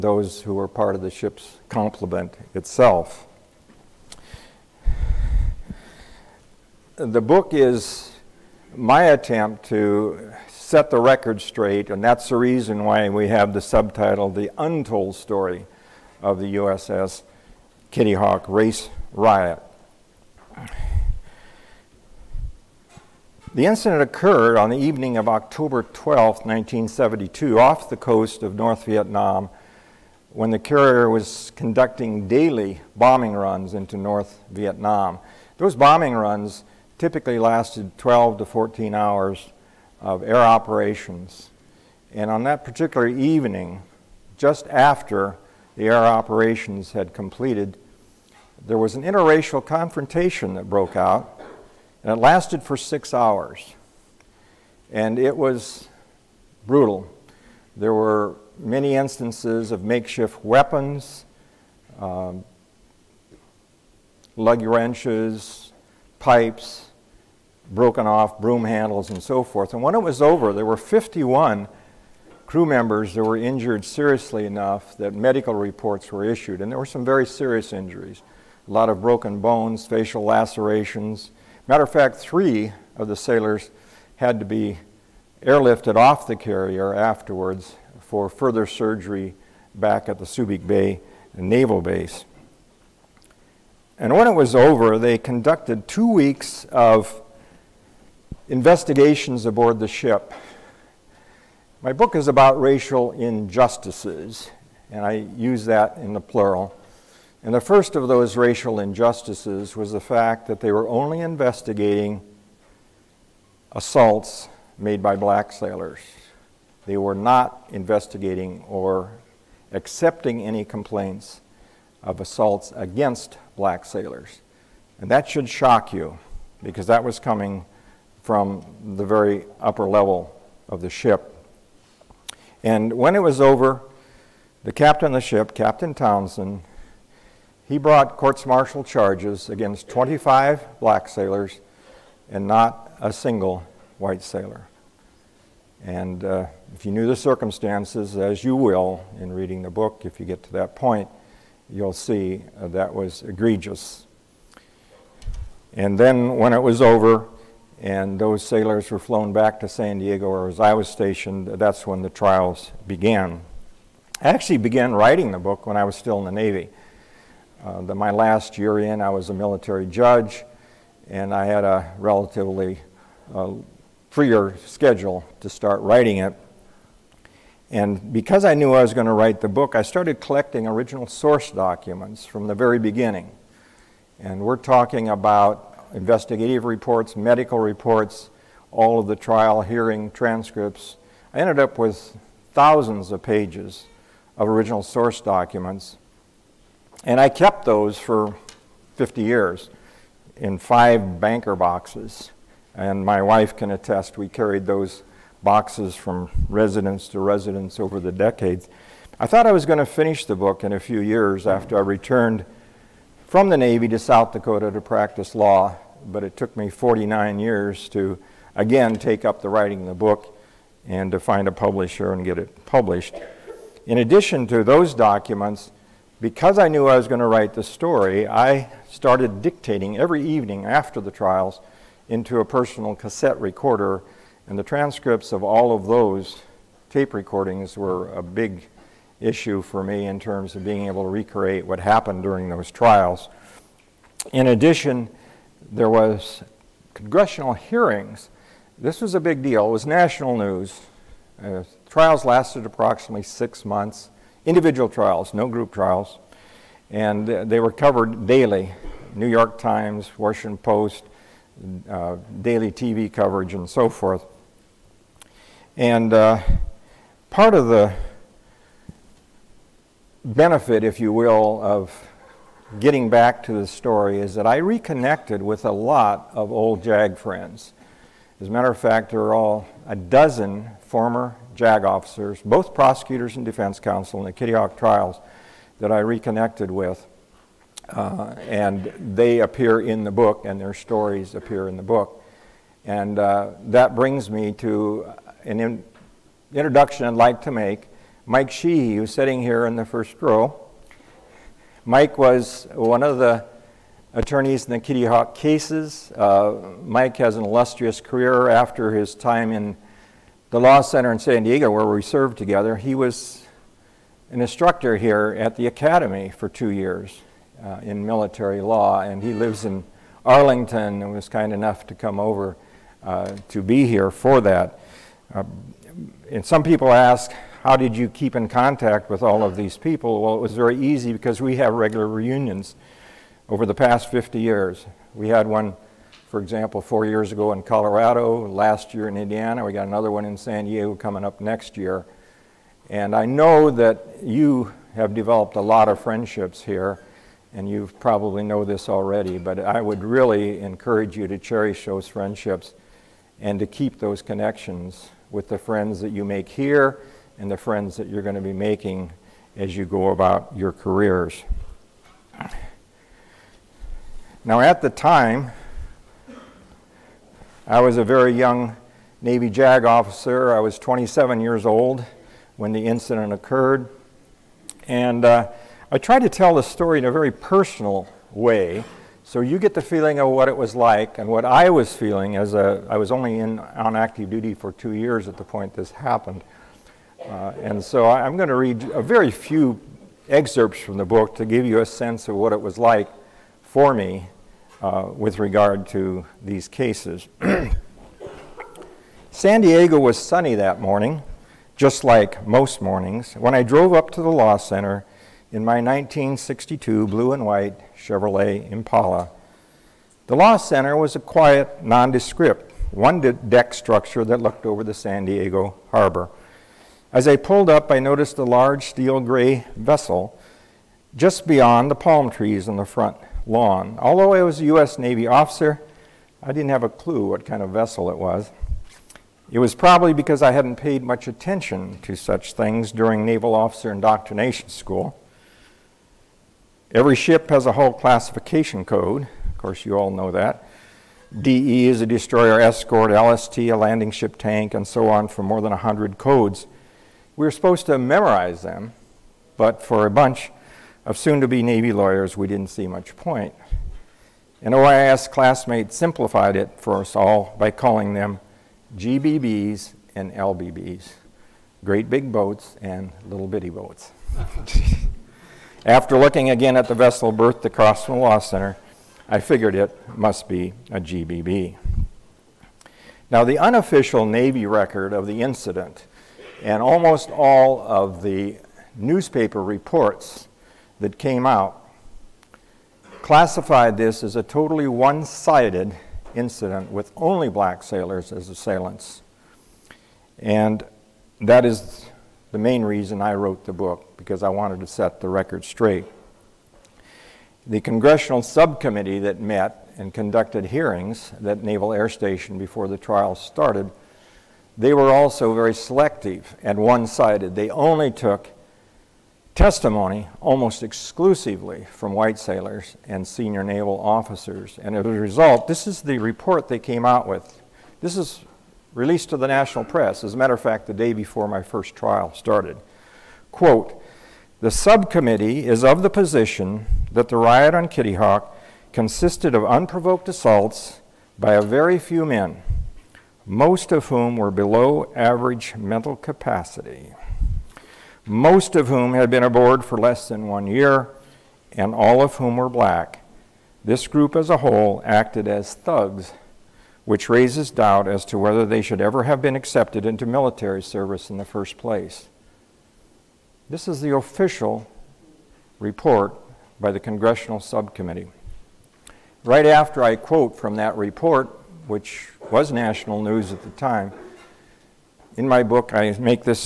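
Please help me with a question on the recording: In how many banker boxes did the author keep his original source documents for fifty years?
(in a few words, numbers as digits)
5.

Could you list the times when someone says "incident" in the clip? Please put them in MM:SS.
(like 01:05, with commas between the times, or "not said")
00:23, 06:12, 07:55, 08:06.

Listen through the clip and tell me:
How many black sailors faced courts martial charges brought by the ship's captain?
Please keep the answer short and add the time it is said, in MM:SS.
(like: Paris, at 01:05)
25, at 02:19.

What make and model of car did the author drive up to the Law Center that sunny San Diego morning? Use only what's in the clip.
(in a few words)
1962 Chevrolet Impala.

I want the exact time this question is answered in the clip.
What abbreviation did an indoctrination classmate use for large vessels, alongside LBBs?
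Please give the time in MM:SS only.
07:38.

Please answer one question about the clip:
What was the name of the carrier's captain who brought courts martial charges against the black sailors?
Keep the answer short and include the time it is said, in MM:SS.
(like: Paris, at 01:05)
Captain Townsend, at 02:15.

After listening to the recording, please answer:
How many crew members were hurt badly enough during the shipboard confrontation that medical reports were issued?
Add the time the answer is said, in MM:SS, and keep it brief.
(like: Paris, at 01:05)
51, at 01:10.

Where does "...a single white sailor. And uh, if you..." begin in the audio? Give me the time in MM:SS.
02:23.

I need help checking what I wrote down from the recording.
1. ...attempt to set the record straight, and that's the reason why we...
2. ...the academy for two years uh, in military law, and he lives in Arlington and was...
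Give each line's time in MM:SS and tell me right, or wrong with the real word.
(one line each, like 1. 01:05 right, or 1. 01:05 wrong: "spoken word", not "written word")
1. 00:09 right
2. 05:15 right.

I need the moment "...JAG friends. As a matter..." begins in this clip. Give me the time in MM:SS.
04:36.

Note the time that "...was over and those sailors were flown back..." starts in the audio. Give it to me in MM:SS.
02:36.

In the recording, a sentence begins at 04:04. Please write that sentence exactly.
In addition, there was congressional hearings.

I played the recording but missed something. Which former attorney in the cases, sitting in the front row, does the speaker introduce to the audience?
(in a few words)
Mike Sheehy.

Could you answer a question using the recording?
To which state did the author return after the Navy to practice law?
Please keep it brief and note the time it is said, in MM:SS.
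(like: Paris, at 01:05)
South Dakota, at 03:33.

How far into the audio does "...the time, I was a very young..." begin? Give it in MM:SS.
06:04.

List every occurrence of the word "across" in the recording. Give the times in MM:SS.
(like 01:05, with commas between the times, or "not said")
07:47.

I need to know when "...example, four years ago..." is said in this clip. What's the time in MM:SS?
05:36.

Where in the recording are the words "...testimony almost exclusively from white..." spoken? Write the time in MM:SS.
08:29.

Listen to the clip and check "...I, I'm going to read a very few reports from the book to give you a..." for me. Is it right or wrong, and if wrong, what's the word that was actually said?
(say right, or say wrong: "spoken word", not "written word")
wrong: "excerpts", not "reports".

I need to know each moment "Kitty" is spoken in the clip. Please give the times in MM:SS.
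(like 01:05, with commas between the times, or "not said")
00:17, 04:44, 05:04, 08:47.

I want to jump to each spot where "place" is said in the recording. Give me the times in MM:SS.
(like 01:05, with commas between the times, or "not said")
09:11.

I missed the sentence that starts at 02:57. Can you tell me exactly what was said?
And because I knew I was going to write the book, I started collecting original source documents from the very beginning.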